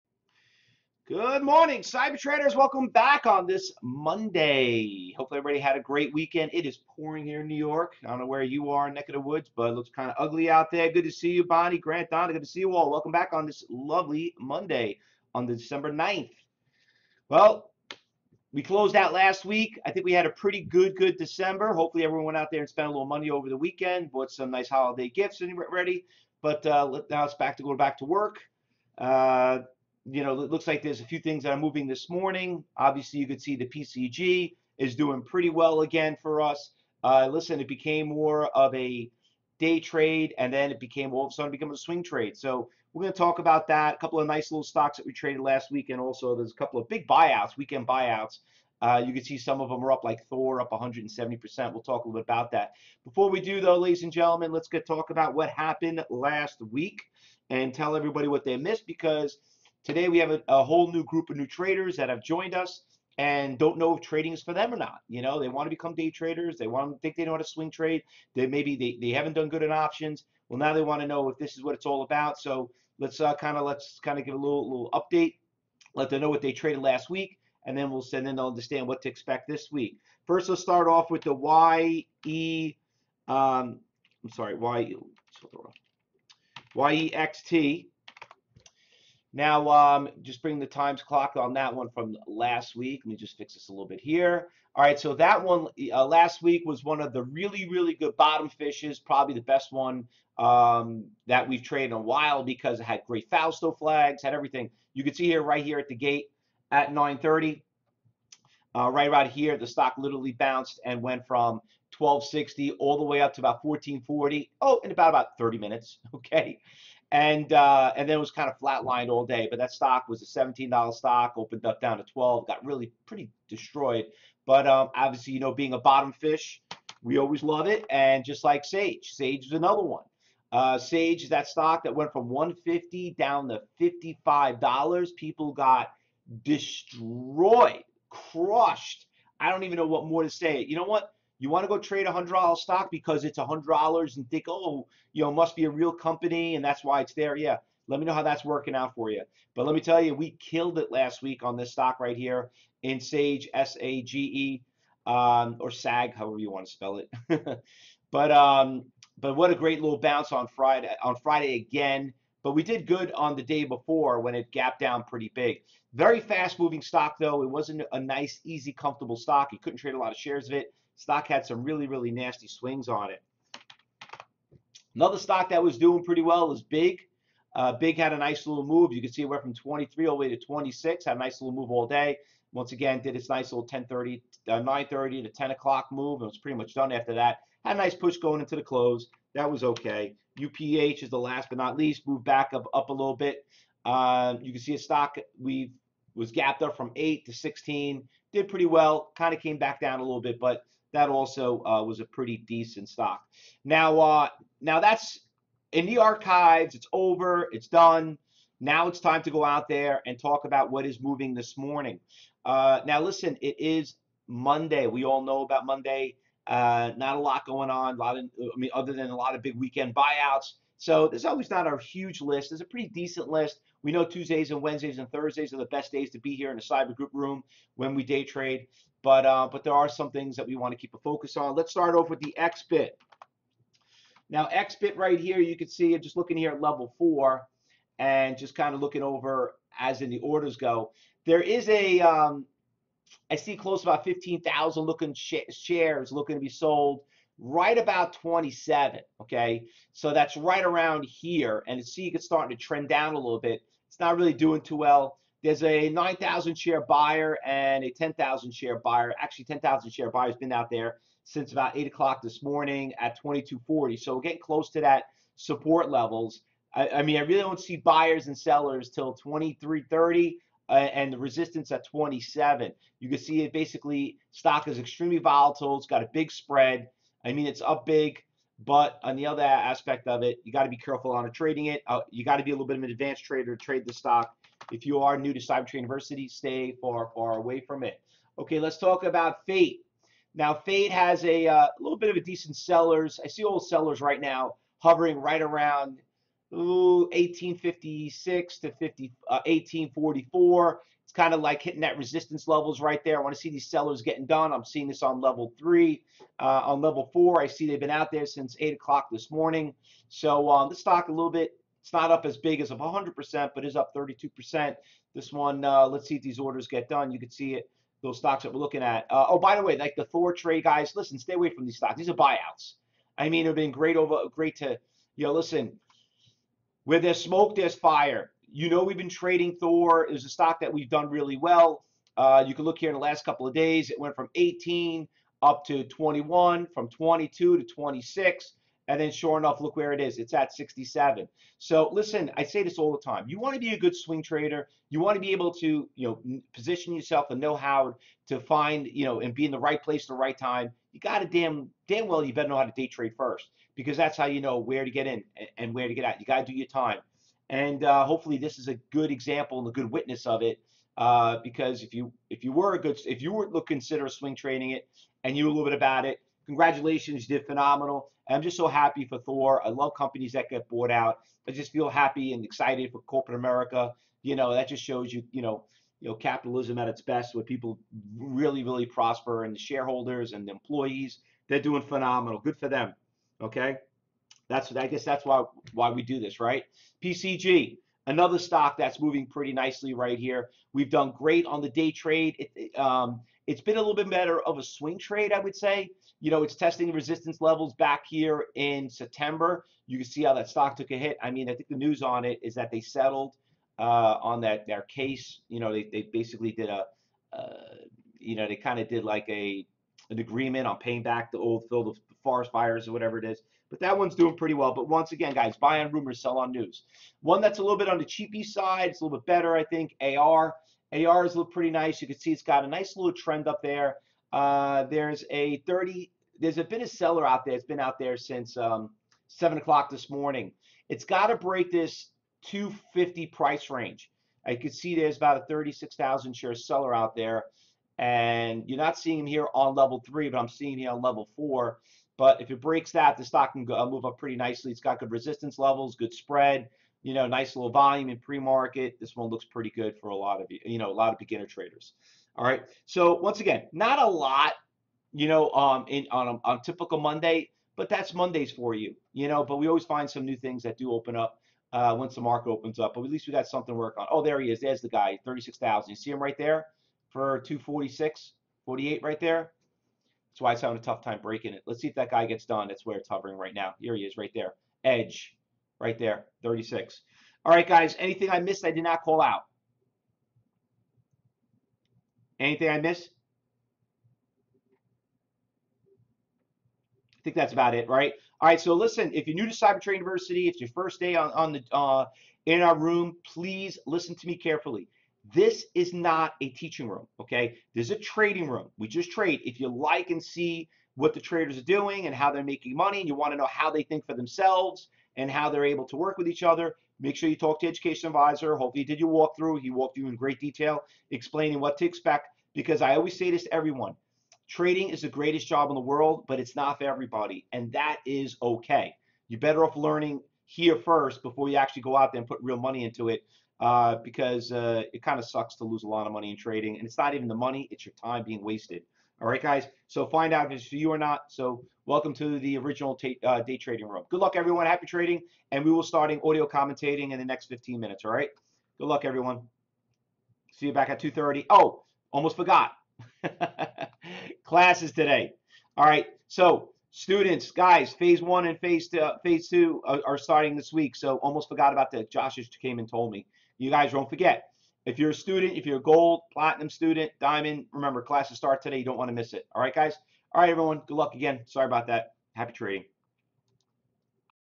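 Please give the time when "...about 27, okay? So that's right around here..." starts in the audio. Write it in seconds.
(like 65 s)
247 s.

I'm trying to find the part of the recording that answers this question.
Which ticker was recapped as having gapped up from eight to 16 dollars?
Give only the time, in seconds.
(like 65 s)
190 s.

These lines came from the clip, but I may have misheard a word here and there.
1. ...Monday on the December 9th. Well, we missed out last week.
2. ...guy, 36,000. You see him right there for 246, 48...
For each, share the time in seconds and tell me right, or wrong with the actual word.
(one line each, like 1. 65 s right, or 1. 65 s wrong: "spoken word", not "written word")
1. 14 s wrong: "closed", not "missed"
2. 464 s right.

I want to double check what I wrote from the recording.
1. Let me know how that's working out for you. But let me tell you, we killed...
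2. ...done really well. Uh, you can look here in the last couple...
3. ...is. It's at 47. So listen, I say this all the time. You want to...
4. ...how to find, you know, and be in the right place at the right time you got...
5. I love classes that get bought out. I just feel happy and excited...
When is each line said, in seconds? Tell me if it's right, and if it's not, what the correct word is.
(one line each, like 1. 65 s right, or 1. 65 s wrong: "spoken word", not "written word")
1. 147 s right
2. 330 s right
3. 340 s wrong: "67", not "47"
4. 347 s right
5. 369 s wrong: "companies", not "classes".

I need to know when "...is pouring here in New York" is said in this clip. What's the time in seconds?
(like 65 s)
6 s.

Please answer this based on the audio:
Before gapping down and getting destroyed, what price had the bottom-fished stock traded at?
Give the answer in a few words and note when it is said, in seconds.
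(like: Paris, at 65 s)
$17, at 120 s.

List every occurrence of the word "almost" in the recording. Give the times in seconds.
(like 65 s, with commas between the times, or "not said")
542 s, 551 s.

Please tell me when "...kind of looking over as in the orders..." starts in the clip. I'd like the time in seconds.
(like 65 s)
238 s.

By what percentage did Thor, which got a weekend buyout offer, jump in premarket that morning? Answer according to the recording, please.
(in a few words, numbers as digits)
170%.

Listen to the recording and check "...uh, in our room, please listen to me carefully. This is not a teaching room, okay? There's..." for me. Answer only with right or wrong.
right.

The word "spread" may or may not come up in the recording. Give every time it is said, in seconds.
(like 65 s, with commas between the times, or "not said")
276 s, 446 s.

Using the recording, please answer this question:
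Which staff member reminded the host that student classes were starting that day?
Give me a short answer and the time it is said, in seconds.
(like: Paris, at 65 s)
Josh, at 552 s.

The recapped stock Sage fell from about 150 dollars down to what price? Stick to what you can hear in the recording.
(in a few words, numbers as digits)
$55.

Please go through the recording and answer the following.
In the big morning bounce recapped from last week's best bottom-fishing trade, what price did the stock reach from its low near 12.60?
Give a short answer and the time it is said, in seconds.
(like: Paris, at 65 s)
14.40, at 113 s.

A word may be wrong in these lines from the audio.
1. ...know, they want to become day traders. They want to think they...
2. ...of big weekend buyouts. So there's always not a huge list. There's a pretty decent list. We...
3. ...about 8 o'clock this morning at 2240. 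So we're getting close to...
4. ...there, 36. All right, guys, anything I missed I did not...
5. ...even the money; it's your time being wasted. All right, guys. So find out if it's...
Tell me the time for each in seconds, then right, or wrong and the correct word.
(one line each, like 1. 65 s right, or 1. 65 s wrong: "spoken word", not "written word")
1. 65 s right
2. 219 s right
3. 261 s right
4. 475 s right
5. 527 s right.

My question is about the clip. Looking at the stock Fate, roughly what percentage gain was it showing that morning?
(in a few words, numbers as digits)
32%.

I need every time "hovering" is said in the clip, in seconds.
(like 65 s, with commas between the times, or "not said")
294 s, 473 s.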